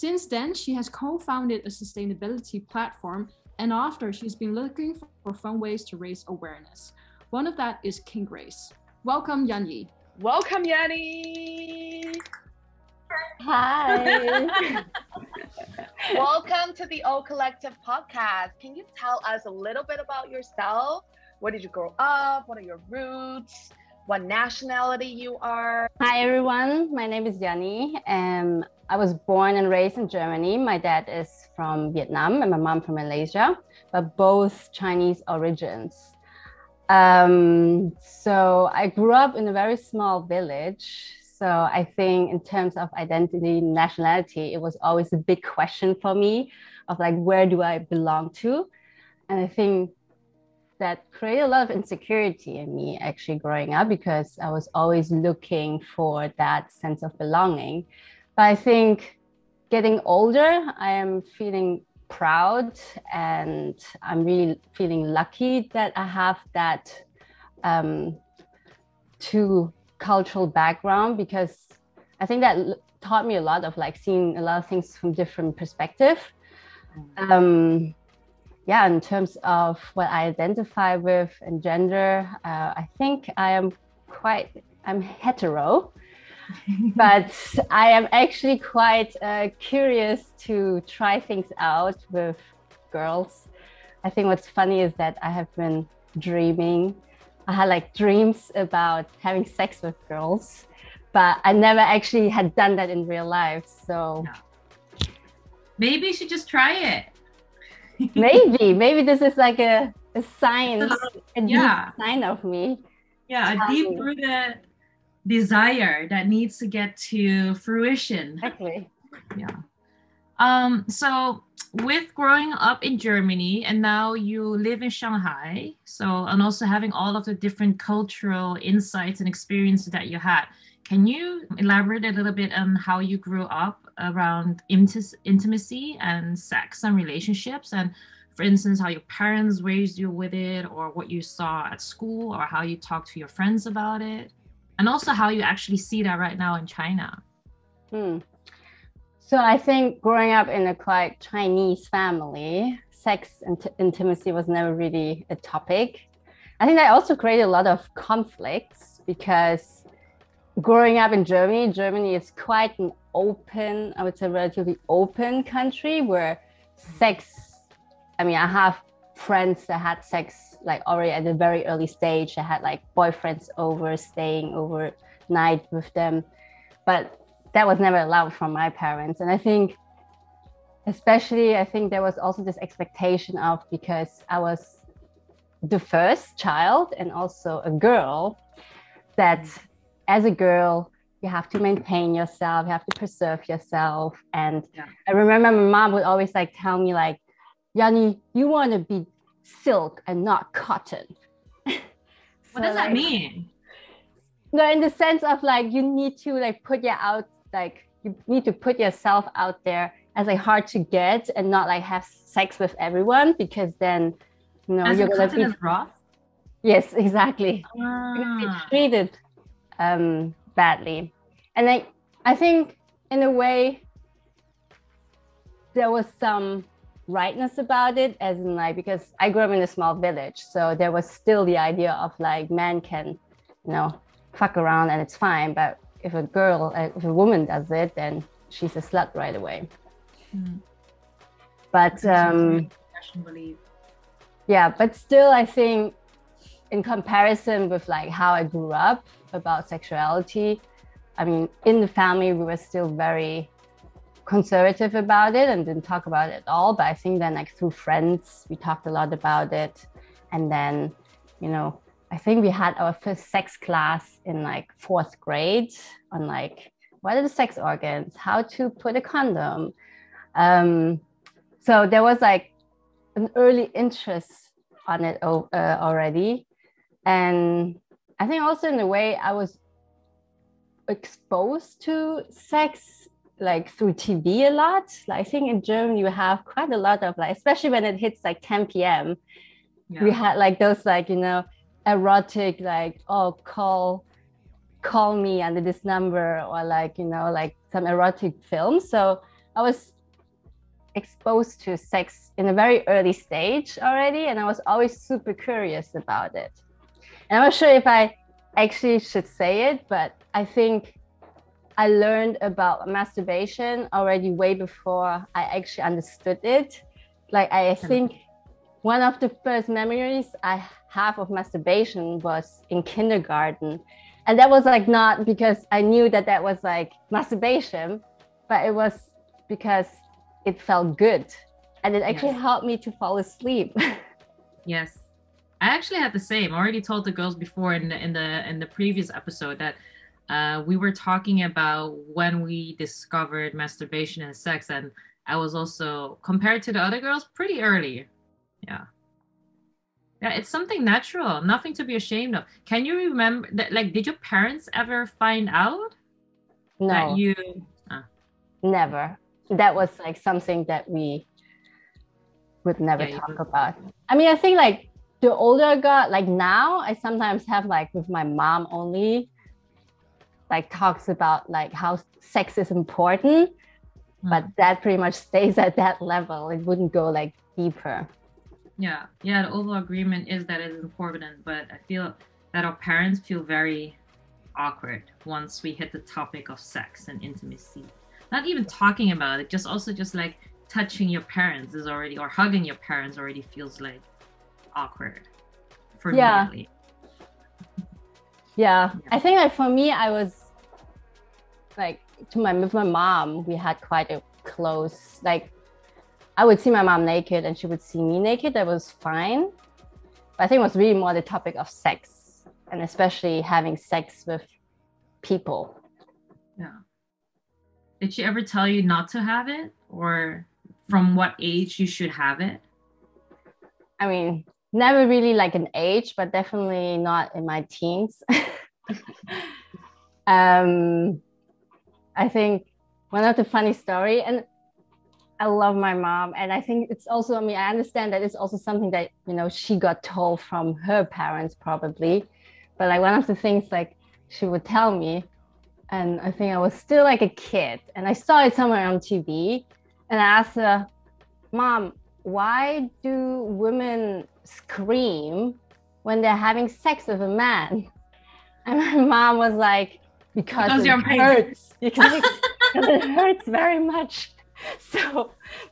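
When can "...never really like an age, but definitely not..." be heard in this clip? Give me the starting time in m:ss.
7:04.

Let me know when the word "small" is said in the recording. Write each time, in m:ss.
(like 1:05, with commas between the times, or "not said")
0:39, 3:49.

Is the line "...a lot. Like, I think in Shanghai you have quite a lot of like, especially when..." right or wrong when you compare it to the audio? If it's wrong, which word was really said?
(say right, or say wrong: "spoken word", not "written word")
wrong: "Germany", not "Shanghai".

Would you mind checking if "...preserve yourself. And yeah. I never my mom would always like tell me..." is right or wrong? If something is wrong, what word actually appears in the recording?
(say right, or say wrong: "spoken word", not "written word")
wrong: "remember", not "never".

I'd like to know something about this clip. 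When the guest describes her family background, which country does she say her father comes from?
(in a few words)
Vietnam.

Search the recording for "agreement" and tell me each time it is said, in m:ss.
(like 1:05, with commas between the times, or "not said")
6:19.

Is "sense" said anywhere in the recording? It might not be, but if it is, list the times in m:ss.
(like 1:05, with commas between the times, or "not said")
0:56, 3:24.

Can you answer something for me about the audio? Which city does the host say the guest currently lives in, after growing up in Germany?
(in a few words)
Shanghai.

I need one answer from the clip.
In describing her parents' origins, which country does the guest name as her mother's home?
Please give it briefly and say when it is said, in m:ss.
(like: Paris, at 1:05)
Malaysia, at 0:32.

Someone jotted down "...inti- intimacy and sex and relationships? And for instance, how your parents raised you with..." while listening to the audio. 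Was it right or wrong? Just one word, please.
right.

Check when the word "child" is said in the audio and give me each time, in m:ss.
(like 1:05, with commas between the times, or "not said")
3:06.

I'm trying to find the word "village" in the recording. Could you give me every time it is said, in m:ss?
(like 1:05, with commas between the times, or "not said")
0:40, 3:49.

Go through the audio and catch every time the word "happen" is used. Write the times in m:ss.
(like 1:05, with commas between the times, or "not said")
not said.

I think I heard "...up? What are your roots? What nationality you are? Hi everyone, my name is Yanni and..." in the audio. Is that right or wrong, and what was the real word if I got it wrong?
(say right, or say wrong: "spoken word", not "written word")
right.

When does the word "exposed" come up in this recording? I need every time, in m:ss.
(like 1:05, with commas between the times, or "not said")
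4:40, 5:00.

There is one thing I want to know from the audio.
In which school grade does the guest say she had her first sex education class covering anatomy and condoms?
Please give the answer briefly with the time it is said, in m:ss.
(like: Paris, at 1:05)
4th grade, at 4:24.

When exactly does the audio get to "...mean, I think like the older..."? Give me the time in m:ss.
6:04.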